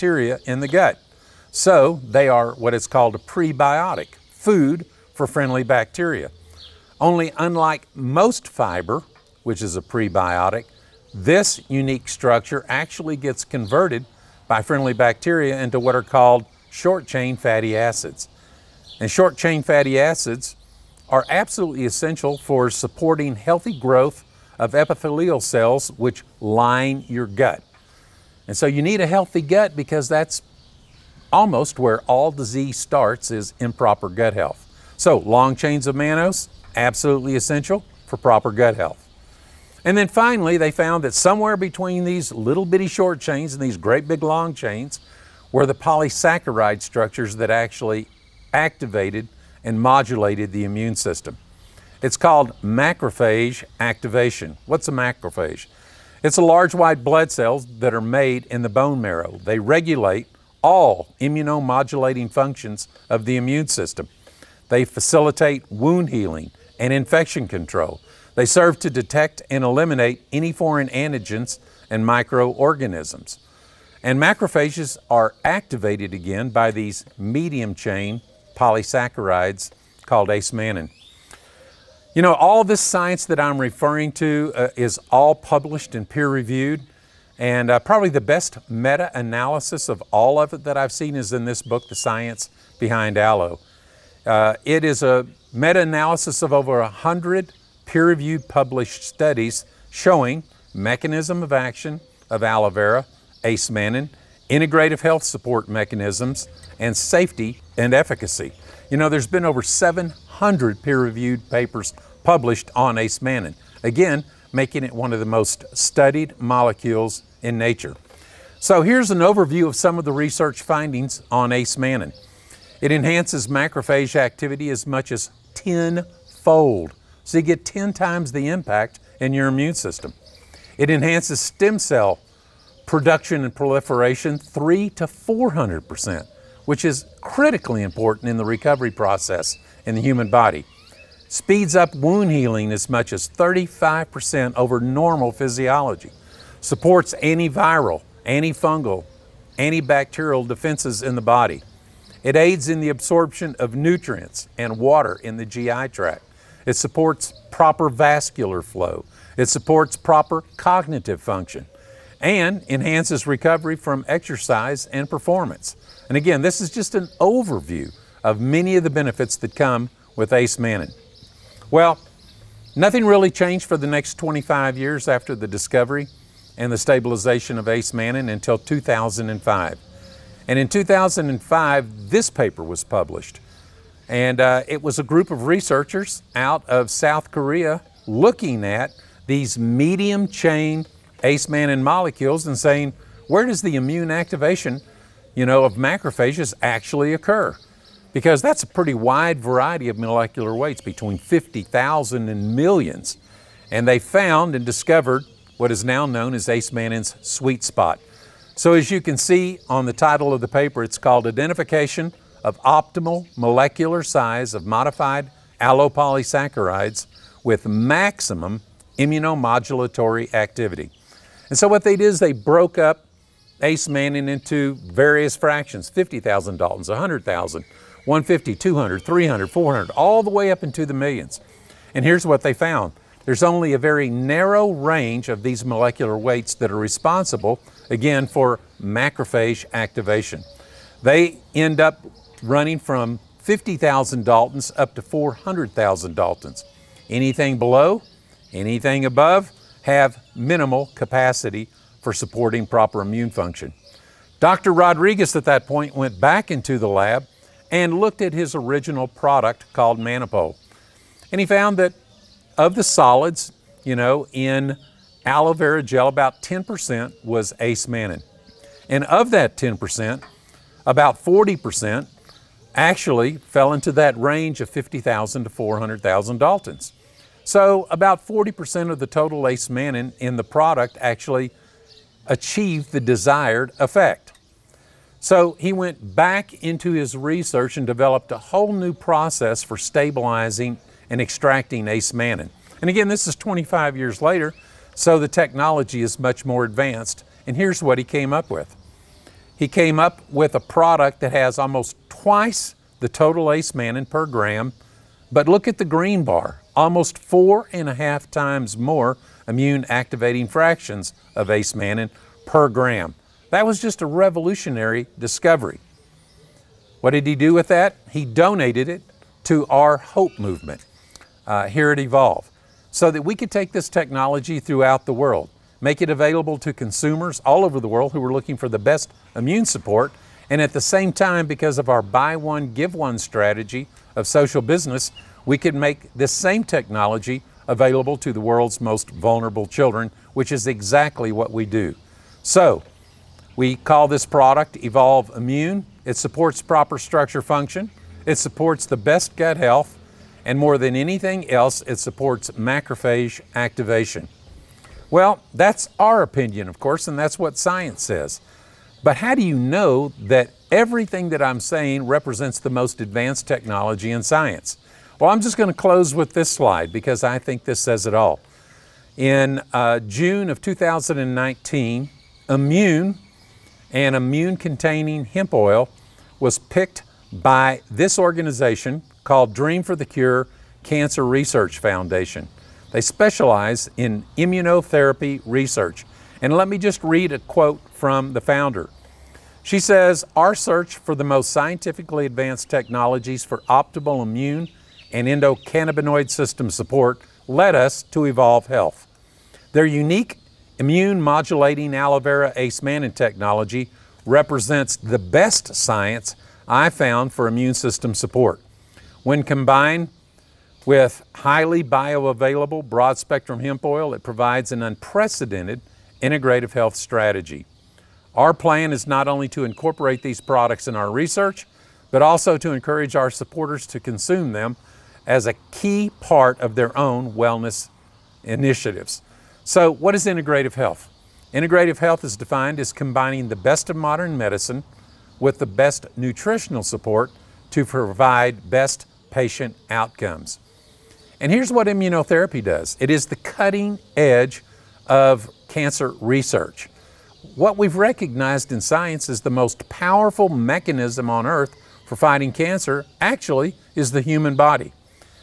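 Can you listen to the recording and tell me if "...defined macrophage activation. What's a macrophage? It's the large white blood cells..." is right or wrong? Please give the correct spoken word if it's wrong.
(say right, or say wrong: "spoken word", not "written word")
wrong: "called", not "defined".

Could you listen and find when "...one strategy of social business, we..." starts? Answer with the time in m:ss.
5:32.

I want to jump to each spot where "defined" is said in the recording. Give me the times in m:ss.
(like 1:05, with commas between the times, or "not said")
7:12.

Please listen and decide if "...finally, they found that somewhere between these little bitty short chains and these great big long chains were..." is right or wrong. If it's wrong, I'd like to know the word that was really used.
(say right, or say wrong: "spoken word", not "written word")
right.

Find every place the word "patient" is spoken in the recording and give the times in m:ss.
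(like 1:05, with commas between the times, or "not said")
7:19.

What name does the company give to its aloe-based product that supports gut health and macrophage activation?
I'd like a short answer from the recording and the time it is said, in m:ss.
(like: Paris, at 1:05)
Evolve Immune, at 5:44.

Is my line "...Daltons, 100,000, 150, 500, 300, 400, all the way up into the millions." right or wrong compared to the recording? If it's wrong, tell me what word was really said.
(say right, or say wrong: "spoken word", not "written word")
wrong: "200", not "500".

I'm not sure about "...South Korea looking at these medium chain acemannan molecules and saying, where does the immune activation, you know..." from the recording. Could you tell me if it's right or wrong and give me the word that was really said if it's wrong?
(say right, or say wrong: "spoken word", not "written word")
right.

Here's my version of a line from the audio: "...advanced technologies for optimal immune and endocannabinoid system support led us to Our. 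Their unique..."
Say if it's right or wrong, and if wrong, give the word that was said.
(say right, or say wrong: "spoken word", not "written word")
wrong: "EvolvHealth", not "Our".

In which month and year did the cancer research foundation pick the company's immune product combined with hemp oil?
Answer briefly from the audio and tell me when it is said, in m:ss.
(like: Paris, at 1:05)
June 2019, at 6:09.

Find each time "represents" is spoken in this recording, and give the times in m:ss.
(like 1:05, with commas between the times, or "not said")
6:02, 6:44.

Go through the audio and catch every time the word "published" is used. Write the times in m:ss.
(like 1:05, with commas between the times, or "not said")
1:25, 1:38, 1:52, 3:02.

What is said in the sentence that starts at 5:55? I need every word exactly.
Well, that's our opinion, of course, and that's what science says.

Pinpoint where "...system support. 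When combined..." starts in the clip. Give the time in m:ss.
6:47.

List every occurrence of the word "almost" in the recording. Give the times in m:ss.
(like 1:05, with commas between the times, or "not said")
0:31, 5:01, 5:06.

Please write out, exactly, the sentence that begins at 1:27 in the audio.
And uh, probably the best meta analysis of all of it that I've seen is in this book, The Science Behind Aloe.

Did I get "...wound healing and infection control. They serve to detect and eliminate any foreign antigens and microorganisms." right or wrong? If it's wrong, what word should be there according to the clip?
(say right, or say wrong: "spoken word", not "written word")
right.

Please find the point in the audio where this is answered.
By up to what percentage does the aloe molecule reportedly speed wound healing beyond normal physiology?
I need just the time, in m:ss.
2:23.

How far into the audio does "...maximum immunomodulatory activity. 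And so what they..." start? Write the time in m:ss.
3:37.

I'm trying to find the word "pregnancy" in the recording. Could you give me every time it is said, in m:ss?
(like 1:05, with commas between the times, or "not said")
not said.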